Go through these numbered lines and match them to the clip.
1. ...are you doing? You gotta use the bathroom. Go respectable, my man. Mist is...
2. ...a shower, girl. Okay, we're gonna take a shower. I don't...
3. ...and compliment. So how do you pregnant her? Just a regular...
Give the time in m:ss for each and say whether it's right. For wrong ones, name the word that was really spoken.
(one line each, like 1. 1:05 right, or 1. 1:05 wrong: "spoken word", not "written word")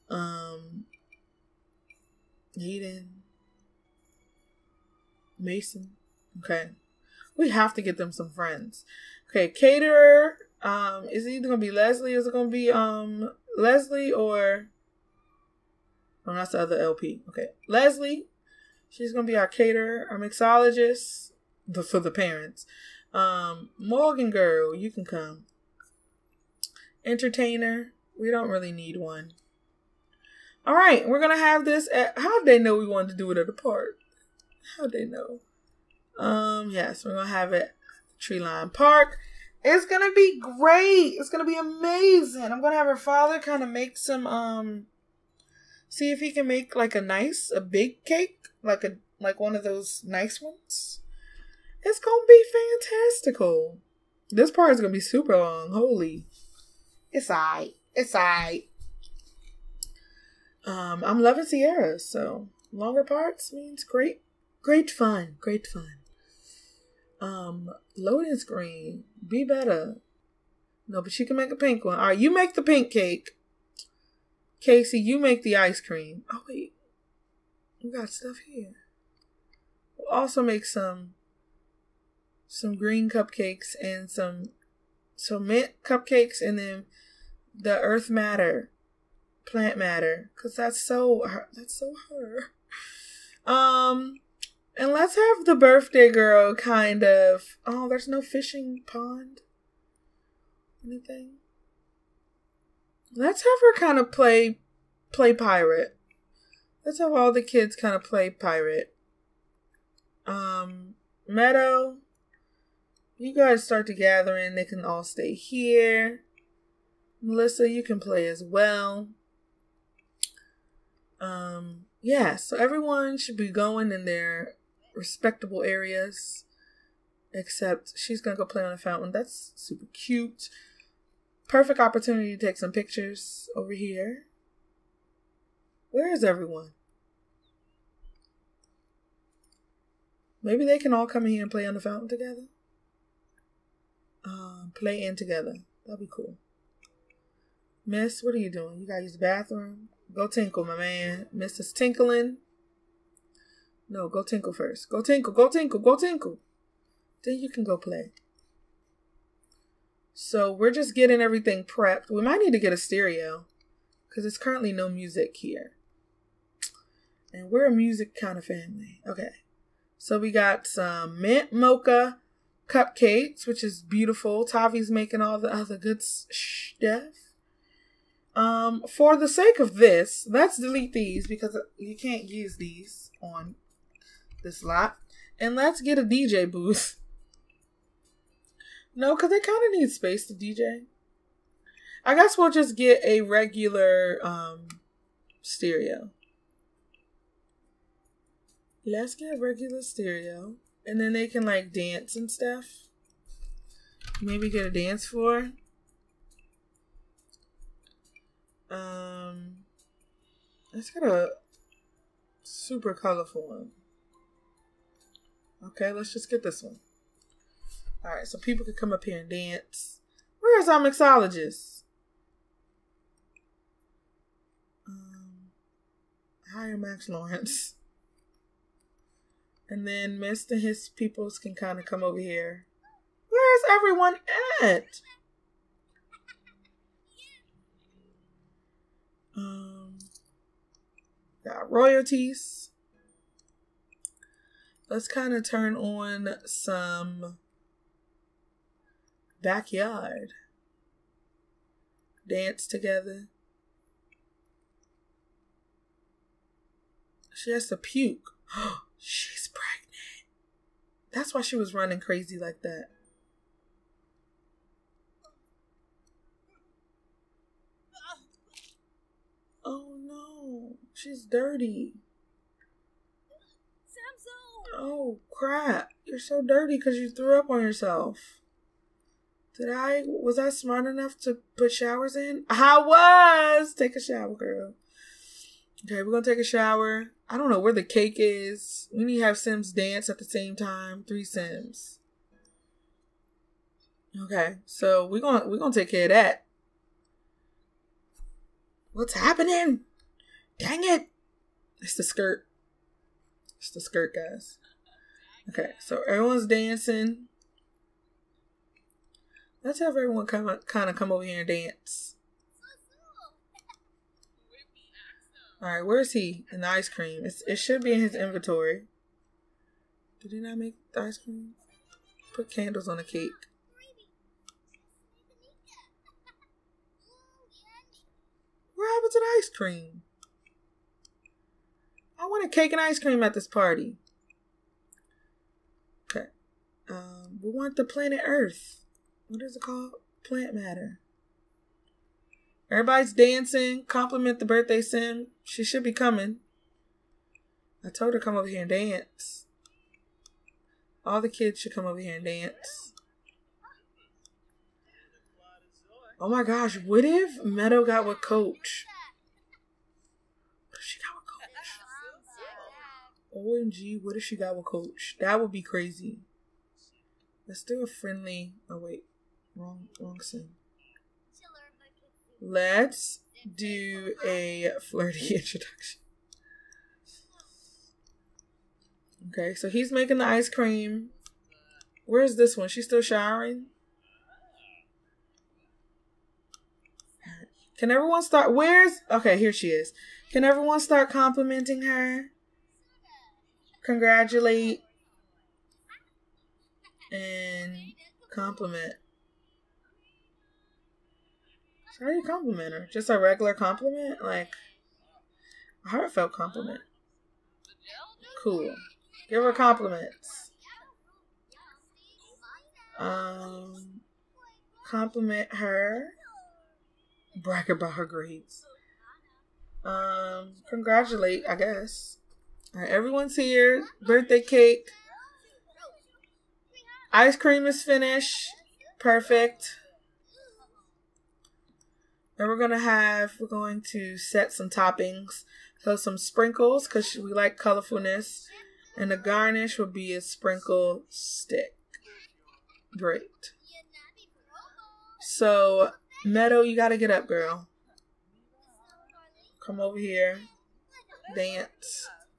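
1. 2:28 wrong: "tinkle", not "respectable"
2. 4:43 right
3. 6:37 wrong: "compliment", not "pregnant".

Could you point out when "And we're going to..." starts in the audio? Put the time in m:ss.
7:12.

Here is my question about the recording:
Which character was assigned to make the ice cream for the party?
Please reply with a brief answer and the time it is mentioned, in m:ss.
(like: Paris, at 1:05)
Kasey, at 1:14.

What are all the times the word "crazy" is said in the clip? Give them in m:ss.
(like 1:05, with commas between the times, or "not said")
4:21, 6:05.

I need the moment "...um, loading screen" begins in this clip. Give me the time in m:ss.
1:07.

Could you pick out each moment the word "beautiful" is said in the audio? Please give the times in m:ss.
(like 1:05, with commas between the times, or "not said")
2:53.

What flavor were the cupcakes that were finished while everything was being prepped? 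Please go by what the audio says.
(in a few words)
mint mocha.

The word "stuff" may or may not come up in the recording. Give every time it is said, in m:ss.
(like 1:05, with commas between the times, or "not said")
1:18, 2:56, 3:22.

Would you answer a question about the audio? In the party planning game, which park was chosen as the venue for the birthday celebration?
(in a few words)
Tree Line Park.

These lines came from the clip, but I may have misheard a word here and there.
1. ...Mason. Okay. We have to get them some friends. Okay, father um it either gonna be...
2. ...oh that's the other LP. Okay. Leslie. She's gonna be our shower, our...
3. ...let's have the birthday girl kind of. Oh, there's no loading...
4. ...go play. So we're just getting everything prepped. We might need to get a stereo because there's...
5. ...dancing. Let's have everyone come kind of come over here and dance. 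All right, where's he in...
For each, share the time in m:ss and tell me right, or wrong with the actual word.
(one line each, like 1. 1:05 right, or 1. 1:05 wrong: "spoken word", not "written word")
1. 0:05 wrong: "caterer", not "father"
2. 0:16 wrong: "caterer", not "shower"
3. 1:34 wrong: "fishing", not "loading"
4. 2:37 right
5. 5:06 right.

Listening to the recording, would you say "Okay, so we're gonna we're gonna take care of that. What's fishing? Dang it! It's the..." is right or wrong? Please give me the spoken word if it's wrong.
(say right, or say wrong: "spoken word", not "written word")
wrong: "happening", not "fishing".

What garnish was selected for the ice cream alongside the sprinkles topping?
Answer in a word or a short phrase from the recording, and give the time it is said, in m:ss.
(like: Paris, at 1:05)
sprinkle stick, at 7:20.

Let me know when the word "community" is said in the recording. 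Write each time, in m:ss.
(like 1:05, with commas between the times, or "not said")
not said.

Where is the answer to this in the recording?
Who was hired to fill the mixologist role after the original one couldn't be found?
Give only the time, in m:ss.
3:46.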